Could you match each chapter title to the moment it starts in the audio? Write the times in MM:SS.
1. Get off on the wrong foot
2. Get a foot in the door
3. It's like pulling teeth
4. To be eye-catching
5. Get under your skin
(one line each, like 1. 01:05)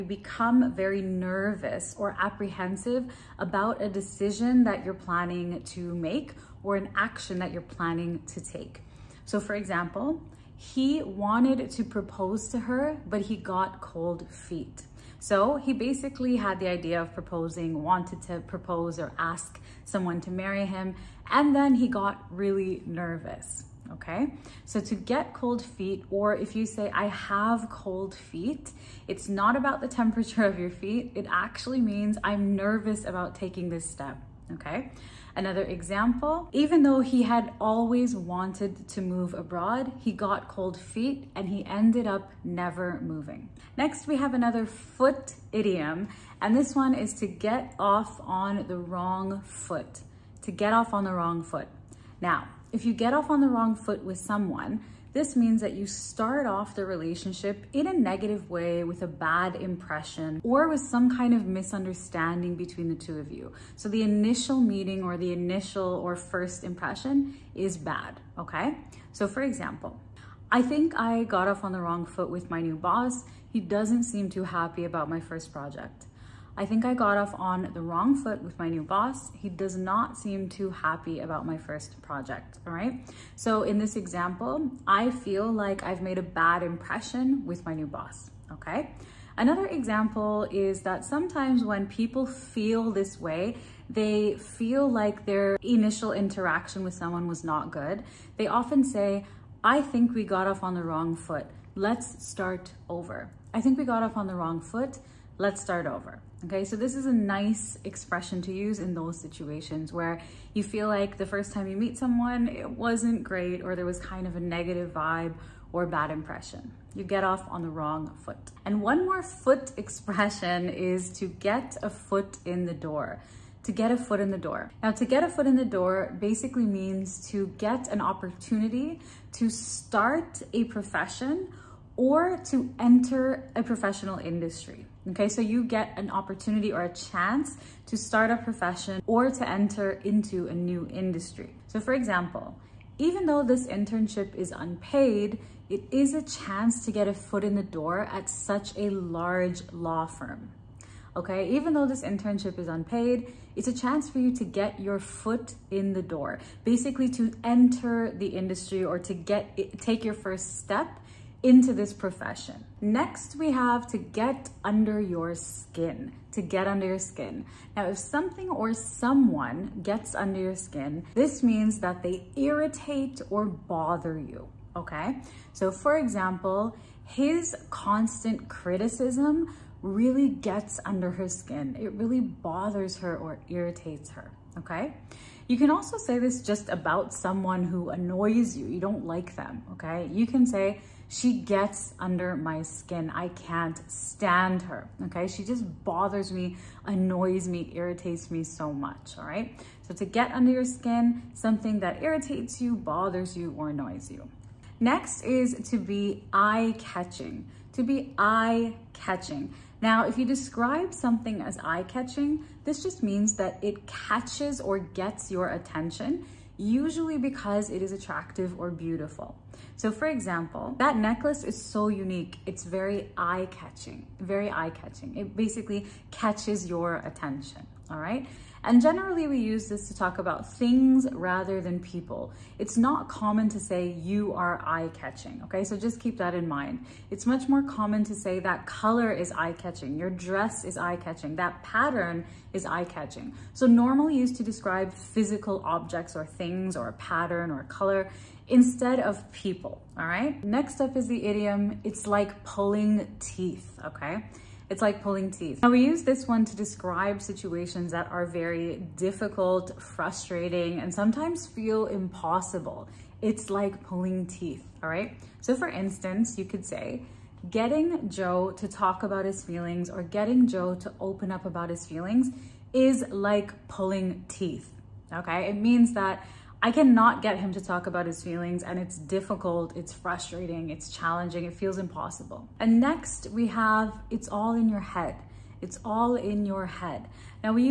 1. 00:43
2. 01:58
3. 04:10
4. 03:24
5. 02:42.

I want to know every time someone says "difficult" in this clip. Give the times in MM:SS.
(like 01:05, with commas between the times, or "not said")
04:18, 04:38.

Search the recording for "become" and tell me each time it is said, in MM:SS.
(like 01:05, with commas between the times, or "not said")
00:00.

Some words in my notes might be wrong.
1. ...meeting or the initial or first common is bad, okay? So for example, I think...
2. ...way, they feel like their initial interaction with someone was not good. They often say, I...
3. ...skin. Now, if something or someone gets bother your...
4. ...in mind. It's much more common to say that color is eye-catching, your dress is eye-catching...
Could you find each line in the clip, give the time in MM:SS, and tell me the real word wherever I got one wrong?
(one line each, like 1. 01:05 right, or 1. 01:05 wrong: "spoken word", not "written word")
1. 01:04 wrong: "impression", not "common"
2. 01:33 right
3. 02:46 wrong: "under", not "bother"
4. 03:56 right.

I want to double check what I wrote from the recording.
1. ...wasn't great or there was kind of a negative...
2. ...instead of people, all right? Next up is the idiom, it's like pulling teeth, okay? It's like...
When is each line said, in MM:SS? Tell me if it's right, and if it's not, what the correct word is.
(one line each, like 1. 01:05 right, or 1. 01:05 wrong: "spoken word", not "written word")
1. 01:52 right
2. 04:08 right.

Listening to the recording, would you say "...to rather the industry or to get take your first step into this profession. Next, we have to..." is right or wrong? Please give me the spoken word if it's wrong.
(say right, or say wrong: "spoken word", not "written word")
wrong: "enter", not "rather".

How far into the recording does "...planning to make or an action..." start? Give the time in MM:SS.
00:04.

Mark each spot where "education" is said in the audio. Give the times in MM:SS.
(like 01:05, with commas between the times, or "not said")
not said.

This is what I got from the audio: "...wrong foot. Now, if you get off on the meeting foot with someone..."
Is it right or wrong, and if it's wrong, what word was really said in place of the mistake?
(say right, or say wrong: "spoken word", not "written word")
wrong: "wrong", not "meeting".